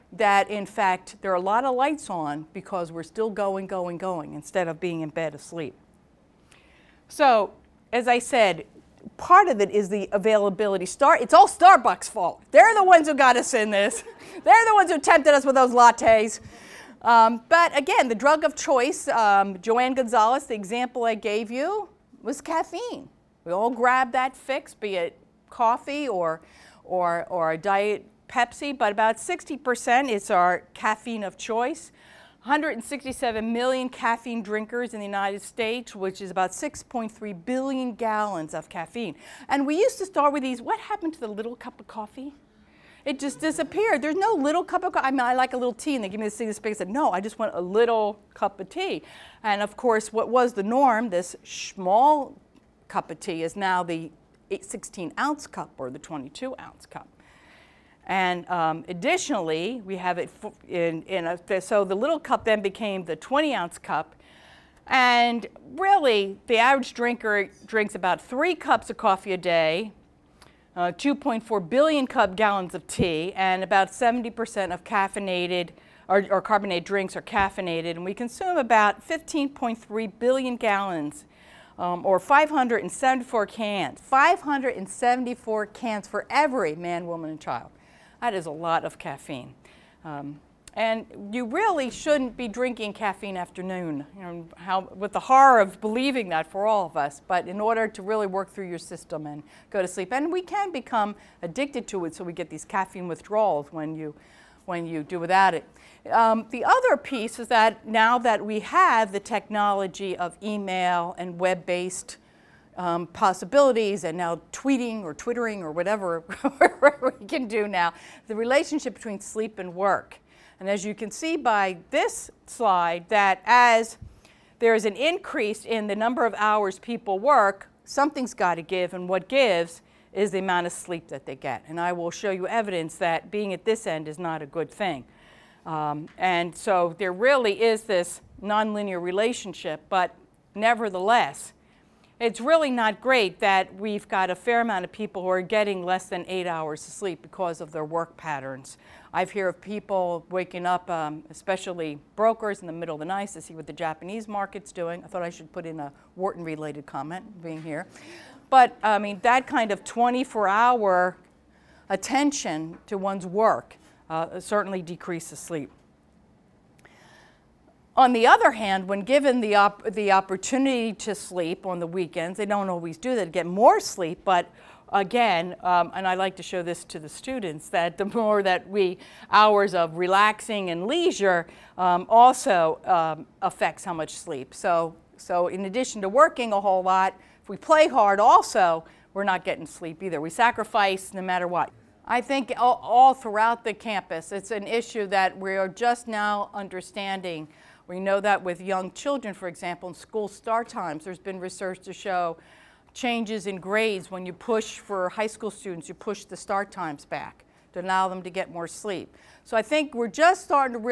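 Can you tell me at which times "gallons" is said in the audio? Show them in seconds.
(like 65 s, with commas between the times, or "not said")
37 s, 72 s, 80 s.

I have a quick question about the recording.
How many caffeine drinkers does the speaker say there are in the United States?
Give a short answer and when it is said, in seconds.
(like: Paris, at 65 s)
167 million, at 32 s.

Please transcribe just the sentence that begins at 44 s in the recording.
There's no little cup of coffee.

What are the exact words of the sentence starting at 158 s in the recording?
But I mean, that kind of 24 hour attention to one's work uh, certainly decreases sleep.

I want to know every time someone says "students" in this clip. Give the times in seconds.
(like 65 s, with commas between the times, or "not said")
177 s, 205 s.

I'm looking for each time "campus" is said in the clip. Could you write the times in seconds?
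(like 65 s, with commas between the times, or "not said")
193 s.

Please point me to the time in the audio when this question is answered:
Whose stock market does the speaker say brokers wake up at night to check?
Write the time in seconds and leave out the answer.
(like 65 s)
153 s.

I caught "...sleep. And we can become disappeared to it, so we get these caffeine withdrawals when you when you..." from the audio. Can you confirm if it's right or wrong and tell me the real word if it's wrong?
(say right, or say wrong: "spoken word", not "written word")
wrong: "addicted", not "disappeared".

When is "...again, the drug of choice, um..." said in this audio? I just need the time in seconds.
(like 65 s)
17 s.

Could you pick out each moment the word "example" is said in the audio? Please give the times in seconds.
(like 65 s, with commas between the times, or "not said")
20 s, 199 s.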